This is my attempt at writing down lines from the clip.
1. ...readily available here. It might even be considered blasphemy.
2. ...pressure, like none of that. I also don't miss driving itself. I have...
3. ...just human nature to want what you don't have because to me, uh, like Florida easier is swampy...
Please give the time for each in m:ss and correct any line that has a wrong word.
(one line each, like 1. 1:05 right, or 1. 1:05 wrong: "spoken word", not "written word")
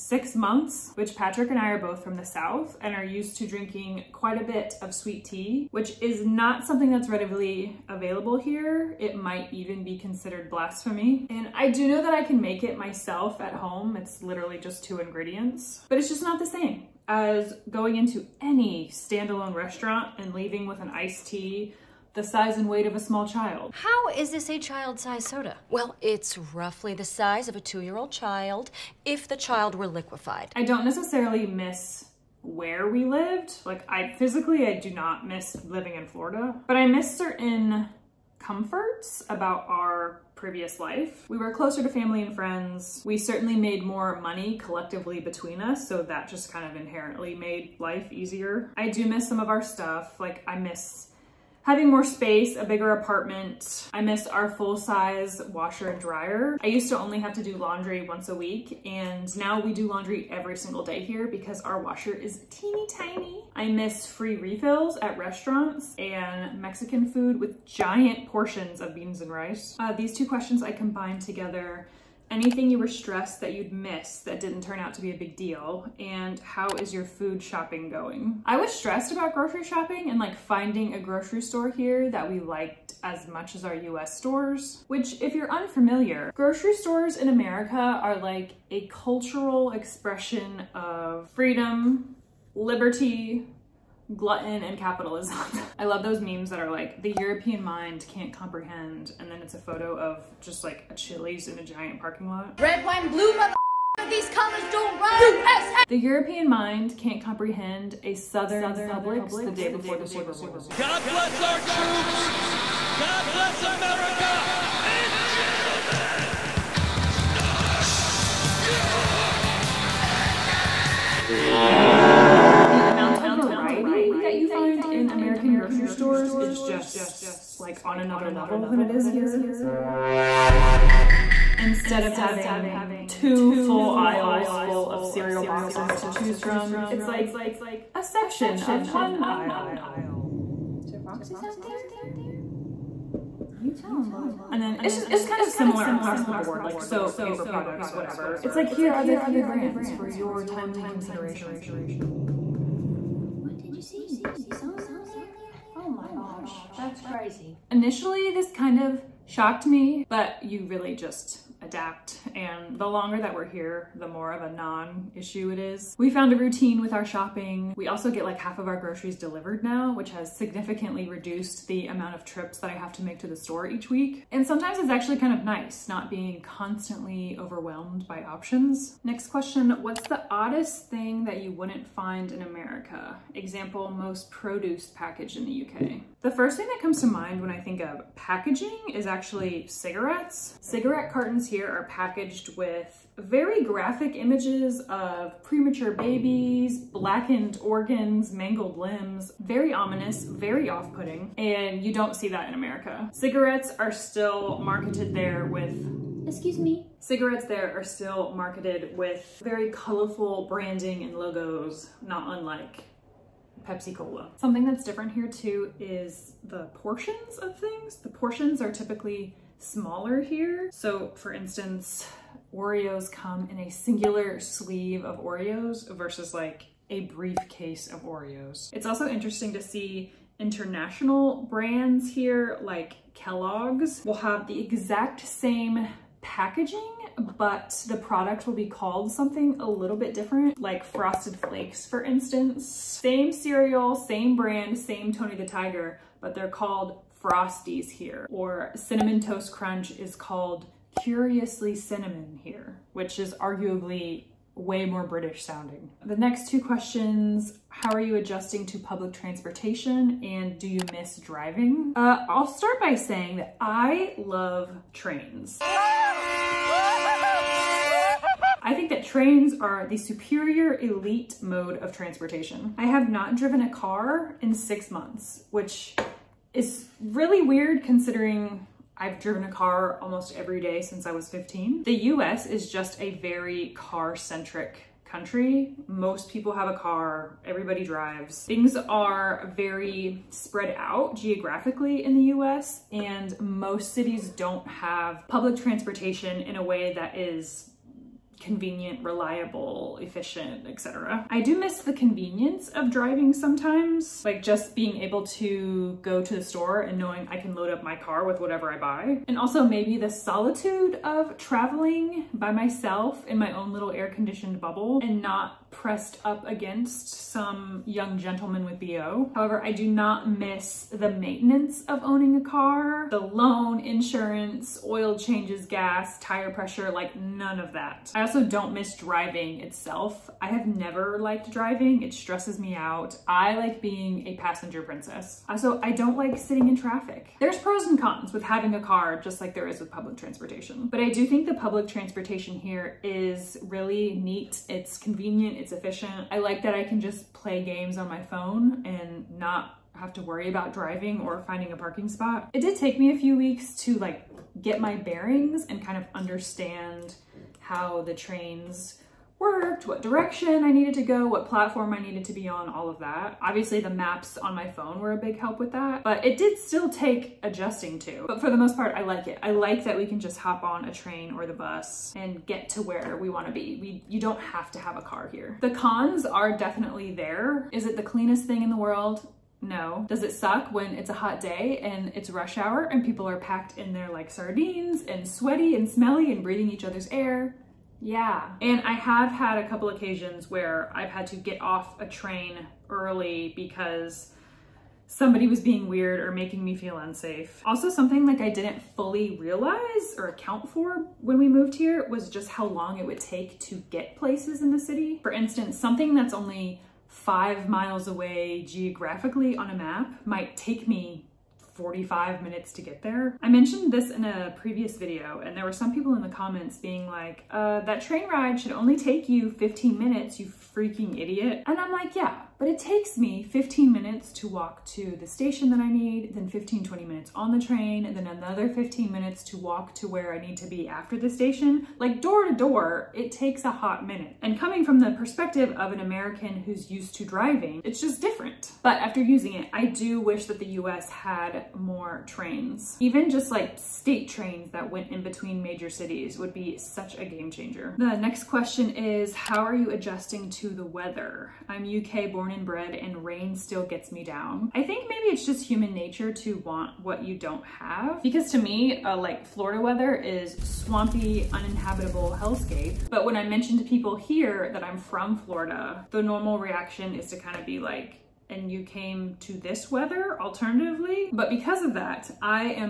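1. 0:07 right
2. 5:26 right
3. 7:35 wrong: "weather", not "easier".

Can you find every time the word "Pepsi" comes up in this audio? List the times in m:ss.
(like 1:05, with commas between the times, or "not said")
3:33.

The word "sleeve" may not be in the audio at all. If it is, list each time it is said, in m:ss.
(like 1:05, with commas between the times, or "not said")
3:44.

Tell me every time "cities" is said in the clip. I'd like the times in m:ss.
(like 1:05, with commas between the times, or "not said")
4:53, 7:25.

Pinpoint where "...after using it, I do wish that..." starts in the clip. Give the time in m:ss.
7:18.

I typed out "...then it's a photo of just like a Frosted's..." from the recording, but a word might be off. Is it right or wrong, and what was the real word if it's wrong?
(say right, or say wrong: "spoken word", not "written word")
wrong: "Chili", not "Frosted".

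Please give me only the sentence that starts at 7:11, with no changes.
Like door to door, it takes a hot minute.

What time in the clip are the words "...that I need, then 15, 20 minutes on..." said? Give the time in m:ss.
7:05.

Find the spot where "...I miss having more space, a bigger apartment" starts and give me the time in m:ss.
0:50.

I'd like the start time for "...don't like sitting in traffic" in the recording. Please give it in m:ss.
5:35.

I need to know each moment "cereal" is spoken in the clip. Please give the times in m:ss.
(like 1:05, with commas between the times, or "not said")
2:15, 4:03.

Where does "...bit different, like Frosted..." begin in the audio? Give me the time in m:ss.
3:59.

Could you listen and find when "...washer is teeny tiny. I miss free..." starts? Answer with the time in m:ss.
1:01.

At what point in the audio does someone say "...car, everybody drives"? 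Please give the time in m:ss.
4:46.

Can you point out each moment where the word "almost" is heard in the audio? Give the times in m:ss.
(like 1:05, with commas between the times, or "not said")
4:39.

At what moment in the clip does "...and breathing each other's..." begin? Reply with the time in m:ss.
6:26.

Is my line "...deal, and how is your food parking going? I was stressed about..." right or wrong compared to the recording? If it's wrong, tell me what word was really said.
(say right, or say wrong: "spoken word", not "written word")
wrong: "shopping", not "parking".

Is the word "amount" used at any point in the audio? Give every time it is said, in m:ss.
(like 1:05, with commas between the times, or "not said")
2:02, 2:51.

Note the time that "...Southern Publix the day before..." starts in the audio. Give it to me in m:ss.
1:48.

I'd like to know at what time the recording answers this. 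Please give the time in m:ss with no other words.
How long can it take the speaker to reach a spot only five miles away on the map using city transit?
6:51.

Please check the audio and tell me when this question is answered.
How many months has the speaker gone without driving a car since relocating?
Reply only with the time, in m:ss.
4:34.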